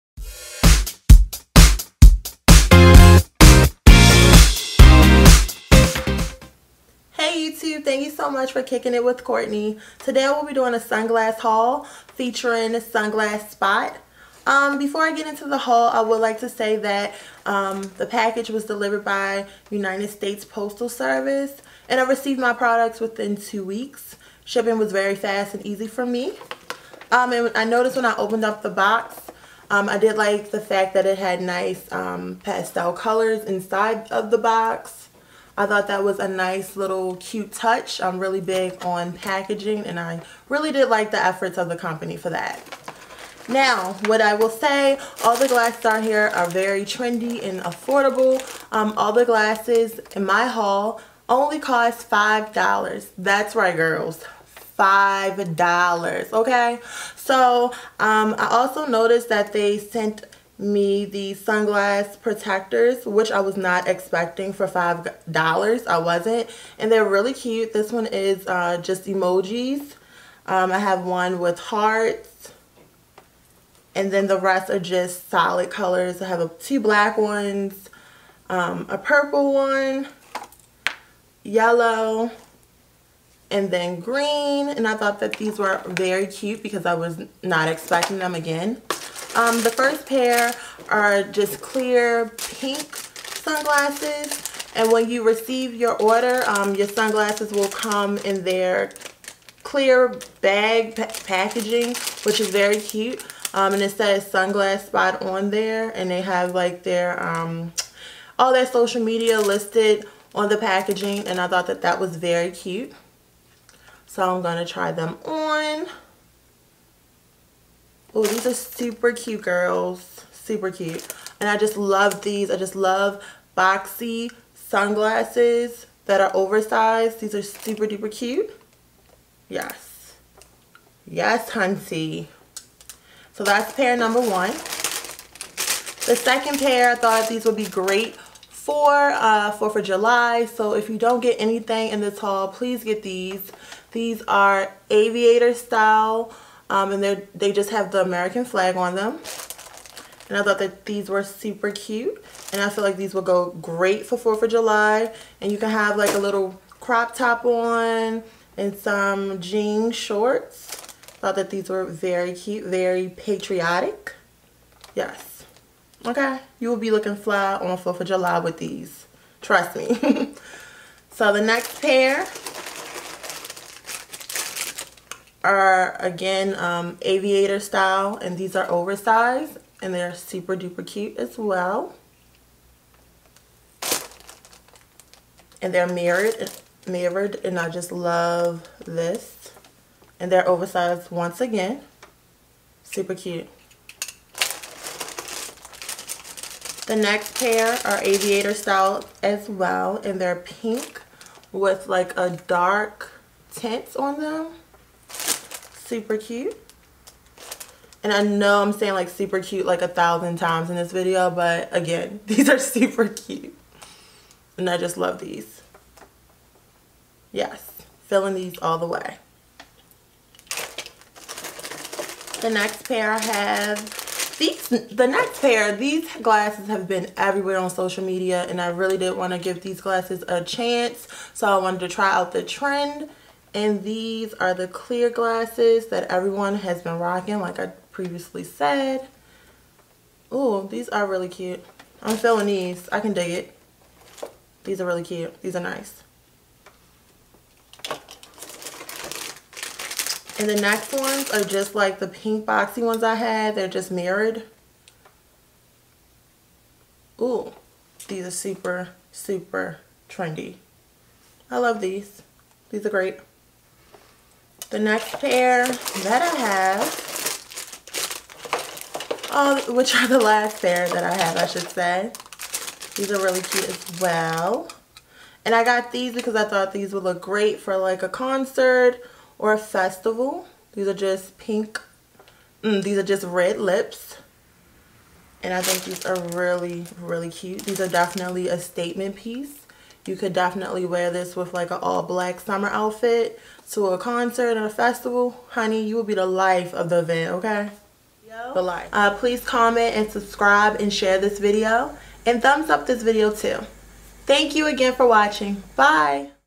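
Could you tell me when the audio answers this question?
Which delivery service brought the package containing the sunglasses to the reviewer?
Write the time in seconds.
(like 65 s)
19 s.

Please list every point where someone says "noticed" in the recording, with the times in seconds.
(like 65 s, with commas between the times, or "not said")
27 s, 58 s.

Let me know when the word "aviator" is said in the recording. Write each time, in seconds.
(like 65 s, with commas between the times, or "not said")
144 s, 177 s, 198 s.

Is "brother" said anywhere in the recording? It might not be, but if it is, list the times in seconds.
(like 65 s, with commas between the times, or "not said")
not said.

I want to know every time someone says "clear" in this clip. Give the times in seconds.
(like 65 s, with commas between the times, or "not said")
91 s, 99 s, 234 s.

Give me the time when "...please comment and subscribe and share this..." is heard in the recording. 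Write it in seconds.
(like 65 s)
299 s.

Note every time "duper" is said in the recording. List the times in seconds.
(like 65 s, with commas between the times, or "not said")
127 s, 180 s.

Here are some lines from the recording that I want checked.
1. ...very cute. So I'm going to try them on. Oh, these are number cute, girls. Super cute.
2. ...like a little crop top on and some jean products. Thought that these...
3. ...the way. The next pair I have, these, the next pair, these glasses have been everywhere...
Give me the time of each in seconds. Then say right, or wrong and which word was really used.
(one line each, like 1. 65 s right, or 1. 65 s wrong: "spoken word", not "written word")
1. 112 s wrong: "super", not "number"
2. 155 s wrong: "shorts", not "products"
3. 218 s right.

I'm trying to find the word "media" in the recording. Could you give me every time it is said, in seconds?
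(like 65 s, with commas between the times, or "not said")
109 s, 228 s.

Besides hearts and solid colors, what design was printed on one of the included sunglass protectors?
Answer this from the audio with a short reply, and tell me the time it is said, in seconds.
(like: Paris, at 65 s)
Emojis, at 69 s.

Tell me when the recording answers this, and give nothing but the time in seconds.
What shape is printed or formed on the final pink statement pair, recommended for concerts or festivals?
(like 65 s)
283 s.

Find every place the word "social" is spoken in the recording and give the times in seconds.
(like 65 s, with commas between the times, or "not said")
108 s, 227 s.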